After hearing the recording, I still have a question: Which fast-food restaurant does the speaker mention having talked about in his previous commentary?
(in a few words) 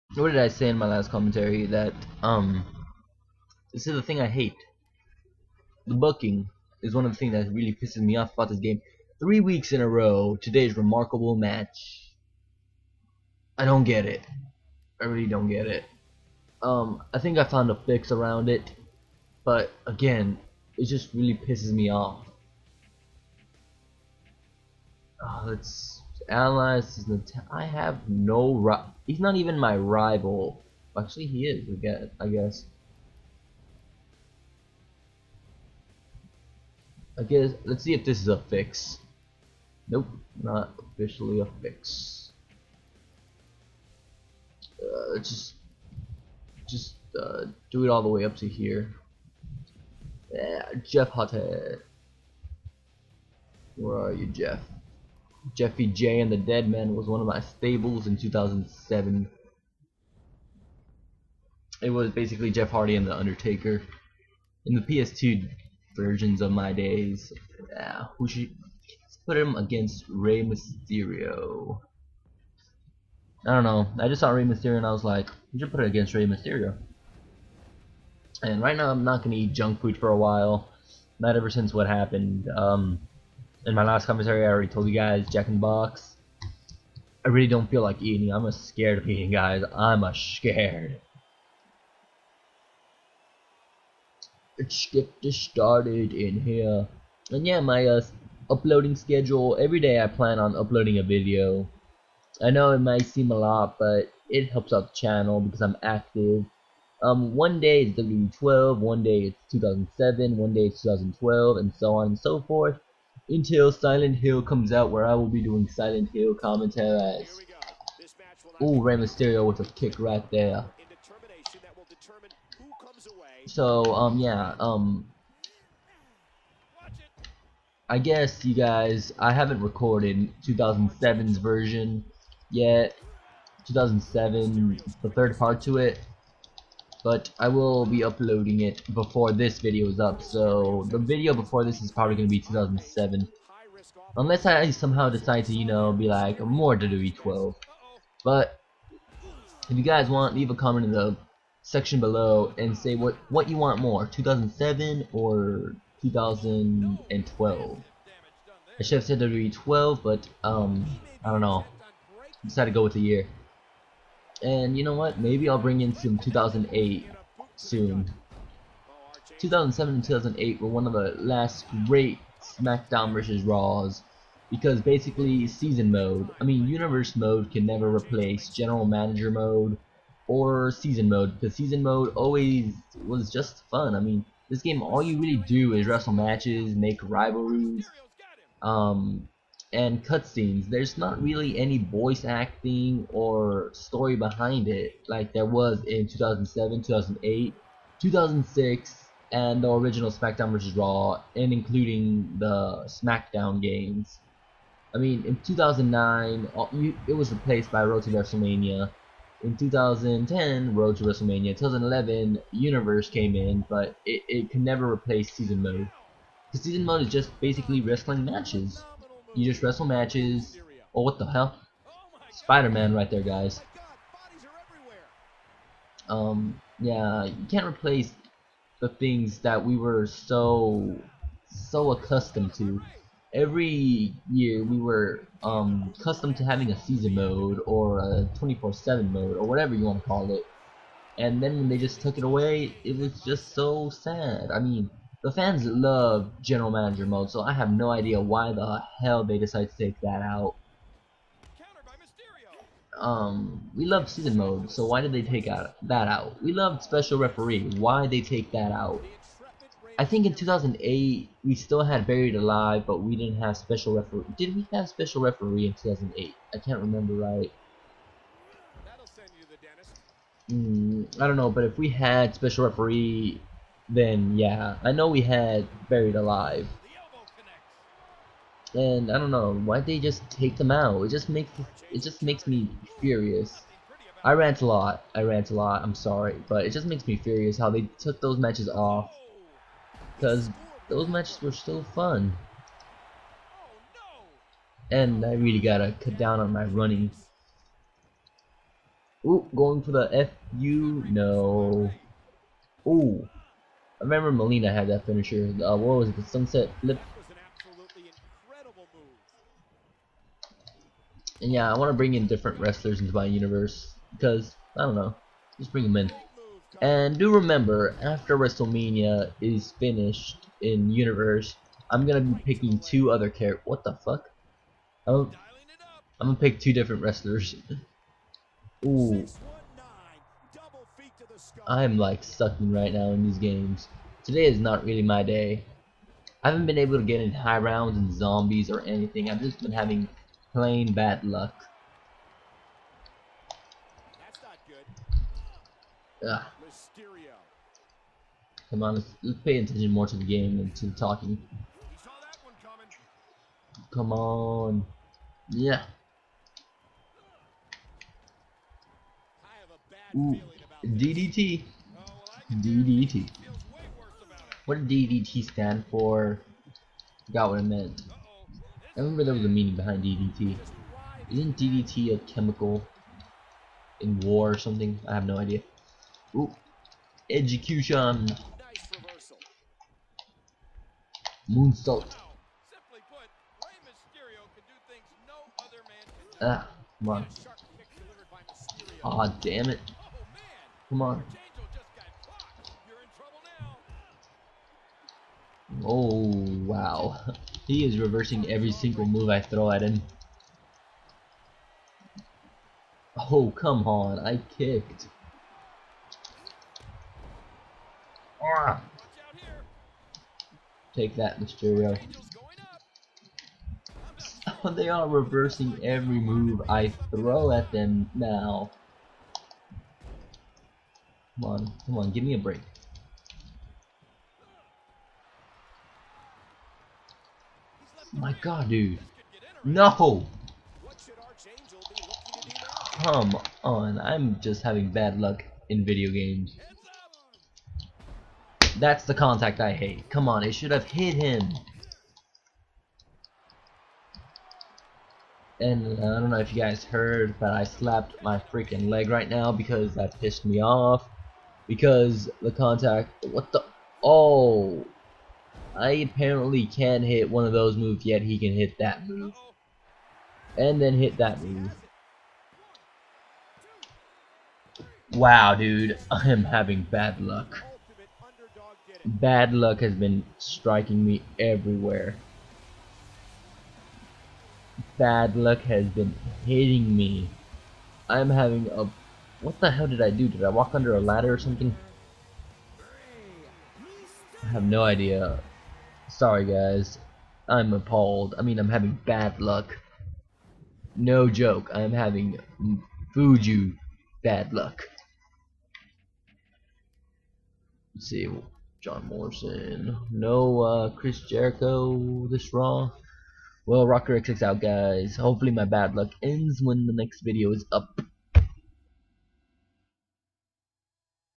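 Jack in the Box.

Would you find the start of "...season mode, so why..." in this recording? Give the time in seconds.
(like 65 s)
254 s.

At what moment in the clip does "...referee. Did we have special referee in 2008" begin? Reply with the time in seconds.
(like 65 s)
263 s.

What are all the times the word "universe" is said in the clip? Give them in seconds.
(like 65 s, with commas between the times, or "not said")
176 s, 212 s, 313 s, 320 s.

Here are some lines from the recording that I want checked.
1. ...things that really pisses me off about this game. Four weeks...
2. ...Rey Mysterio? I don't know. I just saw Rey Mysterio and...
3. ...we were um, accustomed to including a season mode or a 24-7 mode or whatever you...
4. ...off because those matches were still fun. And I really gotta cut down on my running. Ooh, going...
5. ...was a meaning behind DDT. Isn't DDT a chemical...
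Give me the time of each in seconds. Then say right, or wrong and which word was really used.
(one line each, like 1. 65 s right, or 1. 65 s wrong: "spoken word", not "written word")
1. 7 s wrong: "Three", not "Four"
2. 70 s right
3. 234 s wrong: "having", not "including"
4. 288 s right
5. 369 s right.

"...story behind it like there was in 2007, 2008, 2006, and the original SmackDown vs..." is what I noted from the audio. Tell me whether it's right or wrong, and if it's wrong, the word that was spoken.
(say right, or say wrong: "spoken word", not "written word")
right.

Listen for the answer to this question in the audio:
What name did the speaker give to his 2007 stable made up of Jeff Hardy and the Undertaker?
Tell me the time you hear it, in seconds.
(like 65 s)
55 s.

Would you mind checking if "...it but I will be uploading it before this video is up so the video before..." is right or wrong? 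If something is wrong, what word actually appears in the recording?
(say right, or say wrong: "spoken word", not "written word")
right.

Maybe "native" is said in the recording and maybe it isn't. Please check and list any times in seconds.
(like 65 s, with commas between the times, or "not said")
not said.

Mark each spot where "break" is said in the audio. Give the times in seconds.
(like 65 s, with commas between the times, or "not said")
422 s.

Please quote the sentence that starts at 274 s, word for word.
I know we had Buried Alive.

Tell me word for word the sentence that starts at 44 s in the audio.
Uh, let's just just uh, do it all the way up to here.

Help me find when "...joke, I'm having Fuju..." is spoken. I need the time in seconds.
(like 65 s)
491 s.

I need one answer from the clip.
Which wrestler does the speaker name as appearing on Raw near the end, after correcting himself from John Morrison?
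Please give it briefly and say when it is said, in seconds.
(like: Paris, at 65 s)
Chris Jericho, at 500 s.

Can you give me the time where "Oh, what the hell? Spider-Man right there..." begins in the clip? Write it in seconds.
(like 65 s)
220 s.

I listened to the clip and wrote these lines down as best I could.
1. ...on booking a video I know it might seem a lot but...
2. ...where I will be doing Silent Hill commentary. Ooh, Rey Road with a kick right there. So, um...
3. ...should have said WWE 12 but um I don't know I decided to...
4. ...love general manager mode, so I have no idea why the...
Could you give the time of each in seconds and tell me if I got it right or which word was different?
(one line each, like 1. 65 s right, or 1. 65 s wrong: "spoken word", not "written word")
1. 100 s wrong: "uploading", not "booking"
2. 114 s wrong: "Mysterio", not "Road"
3. 158 s right
4. 245 s right.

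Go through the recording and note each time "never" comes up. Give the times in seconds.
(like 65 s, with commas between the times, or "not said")
177 s, 214 s.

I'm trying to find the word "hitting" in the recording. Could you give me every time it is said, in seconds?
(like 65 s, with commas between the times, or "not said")
476 s.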